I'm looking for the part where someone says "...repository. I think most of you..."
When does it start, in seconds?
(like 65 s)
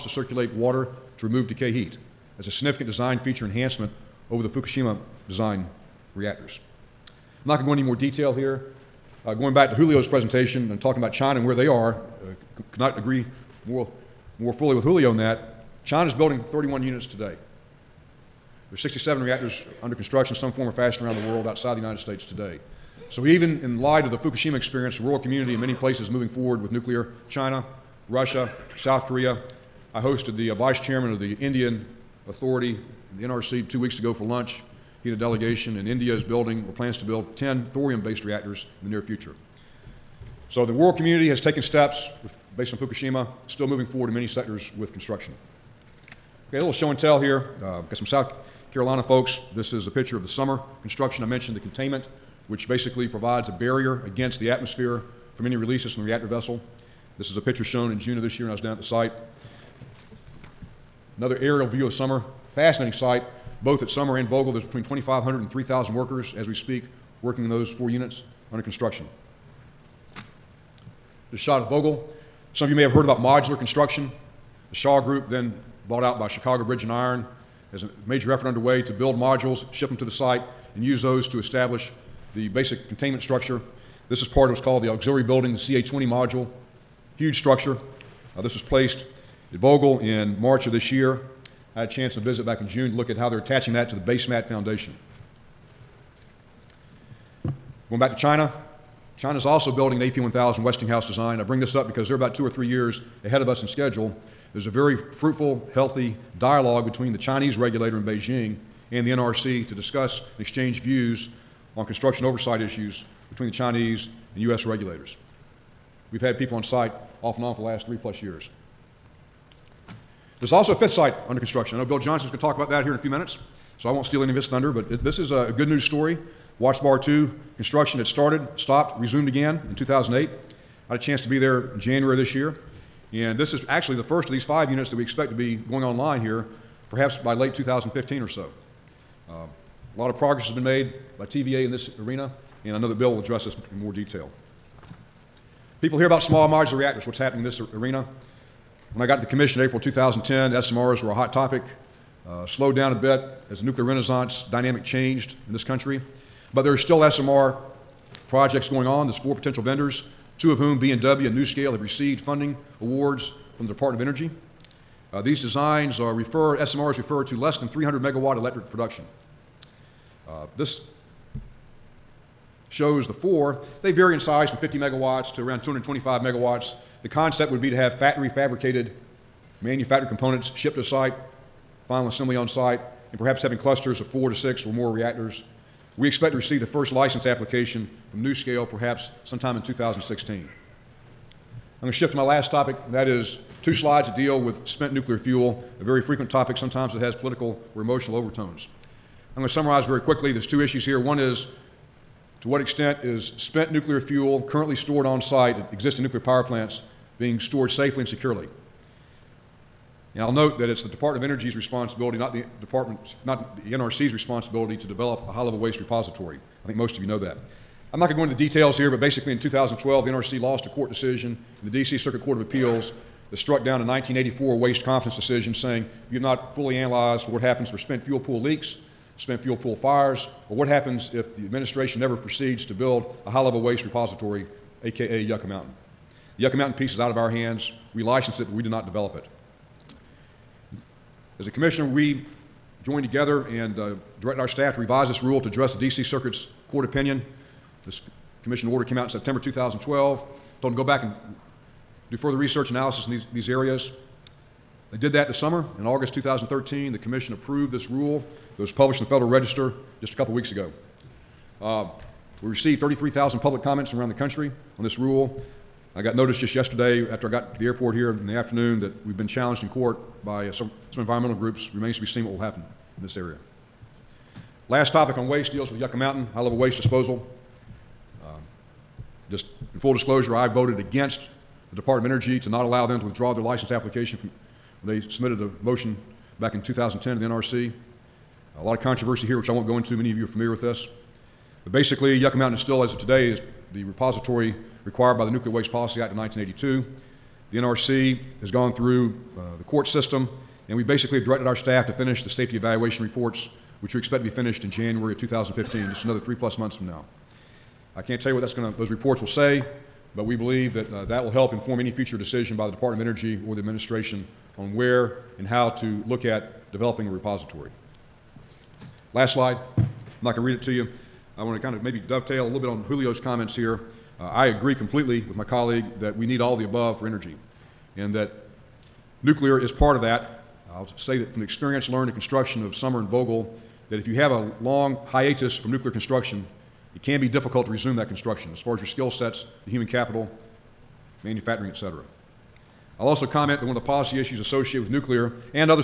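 215 s.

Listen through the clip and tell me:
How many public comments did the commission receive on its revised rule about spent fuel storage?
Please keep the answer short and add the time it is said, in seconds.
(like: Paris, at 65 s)
33,000, at 262 s.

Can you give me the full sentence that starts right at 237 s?
We license it, but we do not develop it.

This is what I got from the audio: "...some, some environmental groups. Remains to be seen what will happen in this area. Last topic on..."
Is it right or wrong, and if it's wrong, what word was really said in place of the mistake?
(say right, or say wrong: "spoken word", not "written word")
right.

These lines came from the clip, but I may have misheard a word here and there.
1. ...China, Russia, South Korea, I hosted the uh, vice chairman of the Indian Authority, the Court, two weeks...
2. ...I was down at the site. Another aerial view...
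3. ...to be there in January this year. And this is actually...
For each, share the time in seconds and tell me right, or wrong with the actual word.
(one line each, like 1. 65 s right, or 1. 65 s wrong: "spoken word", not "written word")
1. 27 s wrong: "NRC", not "Court"
2. 58 s right
3. 131 s right.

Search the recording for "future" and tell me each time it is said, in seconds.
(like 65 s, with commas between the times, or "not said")
39 s, 311 s.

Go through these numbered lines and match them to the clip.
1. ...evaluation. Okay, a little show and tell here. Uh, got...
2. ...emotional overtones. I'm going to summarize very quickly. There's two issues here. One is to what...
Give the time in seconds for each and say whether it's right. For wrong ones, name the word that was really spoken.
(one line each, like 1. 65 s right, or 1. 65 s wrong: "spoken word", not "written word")
1. 44 s wrong: "construction", not "evaluation"
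2. 197 s right.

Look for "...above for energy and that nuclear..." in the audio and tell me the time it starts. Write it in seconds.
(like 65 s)
326 s.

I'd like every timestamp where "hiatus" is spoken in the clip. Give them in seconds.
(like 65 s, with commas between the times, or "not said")
335 s.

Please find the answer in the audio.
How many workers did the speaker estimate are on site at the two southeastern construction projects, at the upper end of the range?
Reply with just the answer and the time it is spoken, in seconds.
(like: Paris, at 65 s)
3,000, at 65 s.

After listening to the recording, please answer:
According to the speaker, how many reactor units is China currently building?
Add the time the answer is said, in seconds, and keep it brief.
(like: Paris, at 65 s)
31, at 16 s.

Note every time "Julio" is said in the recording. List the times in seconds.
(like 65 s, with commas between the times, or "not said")
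9 s, 14 s, 322 s.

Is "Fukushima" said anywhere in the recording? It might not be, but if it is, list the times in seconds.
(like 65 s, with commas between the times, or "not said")
4 s, 24 s, 42 s.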